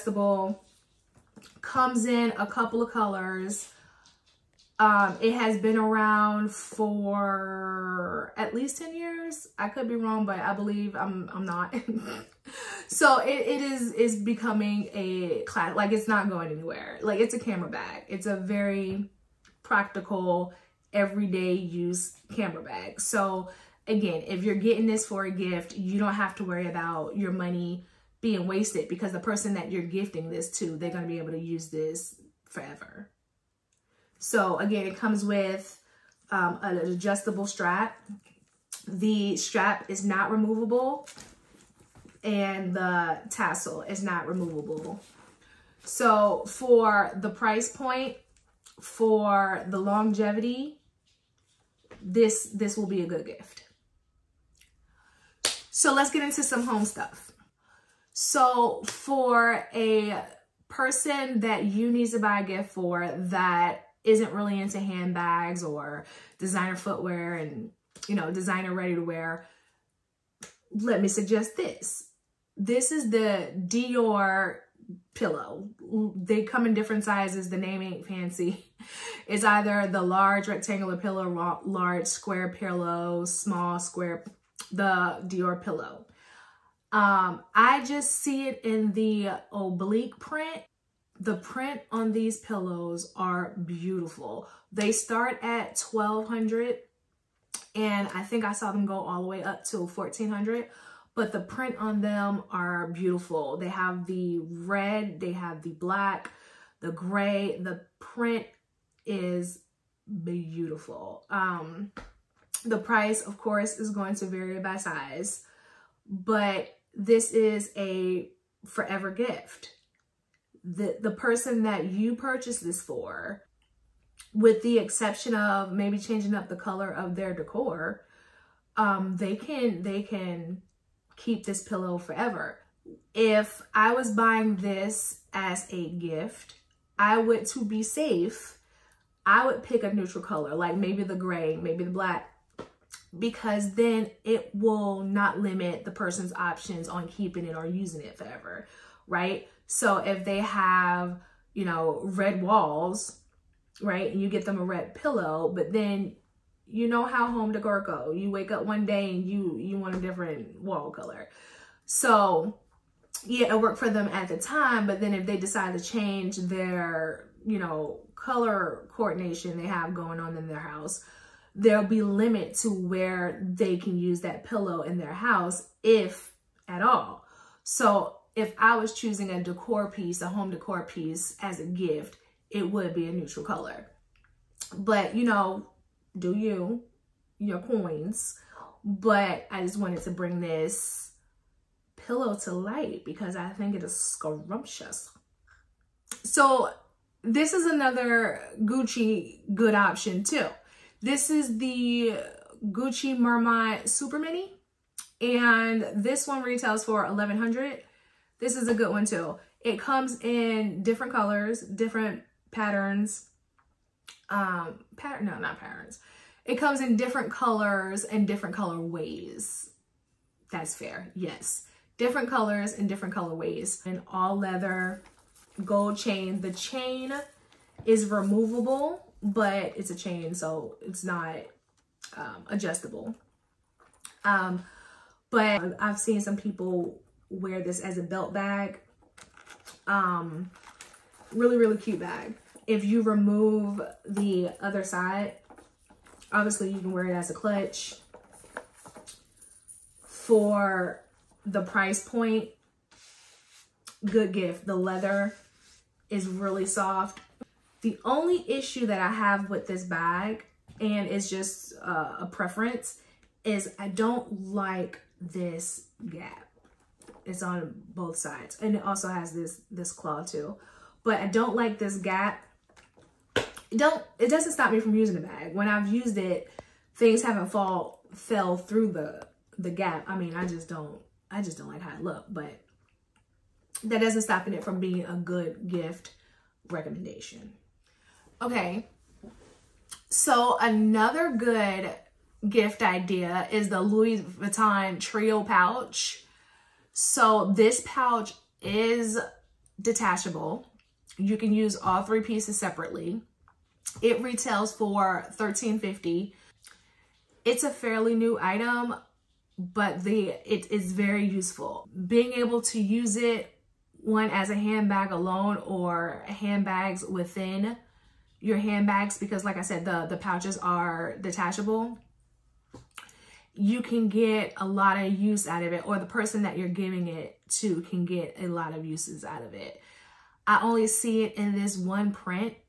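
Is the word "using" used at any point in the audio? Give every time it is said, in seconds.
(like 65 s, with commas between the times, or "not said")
147 s, 274 s.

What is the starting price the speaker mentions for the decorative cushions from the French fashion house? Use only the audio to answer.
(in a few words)
1200.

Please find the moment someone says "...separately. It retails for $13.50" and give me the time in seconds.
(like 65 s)
302 s.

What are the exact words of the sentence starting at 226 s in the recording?
The chain is removable but it's a chain, so it's not um, adjustable.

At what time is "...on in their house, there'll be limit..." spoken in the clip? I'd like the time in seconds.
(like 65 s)
170 s.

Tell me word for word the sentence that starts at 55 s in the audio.
So let's get into some home stuff.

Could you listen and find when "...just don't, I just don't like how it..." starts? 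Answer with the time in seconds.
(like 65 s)
280 s.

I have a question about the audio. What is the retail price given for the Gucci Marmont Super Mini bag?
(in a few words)
1100.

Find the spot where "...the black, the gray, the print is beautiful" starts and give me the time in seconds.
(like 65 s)
105 s.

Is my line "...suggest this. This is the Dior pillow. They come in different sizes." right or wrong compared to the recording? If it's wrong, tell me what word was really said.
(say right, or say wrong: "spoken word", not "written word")
right.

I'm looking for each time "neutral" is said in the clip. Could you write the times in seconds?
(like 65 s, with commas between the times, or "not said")
139 s, 183 s.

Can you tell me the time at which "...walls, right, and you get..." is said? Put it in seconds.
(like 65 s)
152 s.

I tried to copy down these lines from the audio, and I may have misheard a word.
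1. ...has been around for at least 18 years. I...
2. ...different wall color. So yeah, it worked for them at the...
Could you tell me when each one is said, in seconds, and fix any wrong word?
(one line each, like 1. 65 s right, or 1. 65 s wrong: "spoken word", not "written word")
1. 5 s wrong: "10", not "18"
2. 159 s right.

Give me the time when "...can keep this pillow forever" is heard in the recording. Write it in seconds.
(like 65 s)
130 s.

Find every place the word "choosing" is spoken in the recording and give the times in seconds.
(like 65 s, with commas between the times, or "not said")
178 s.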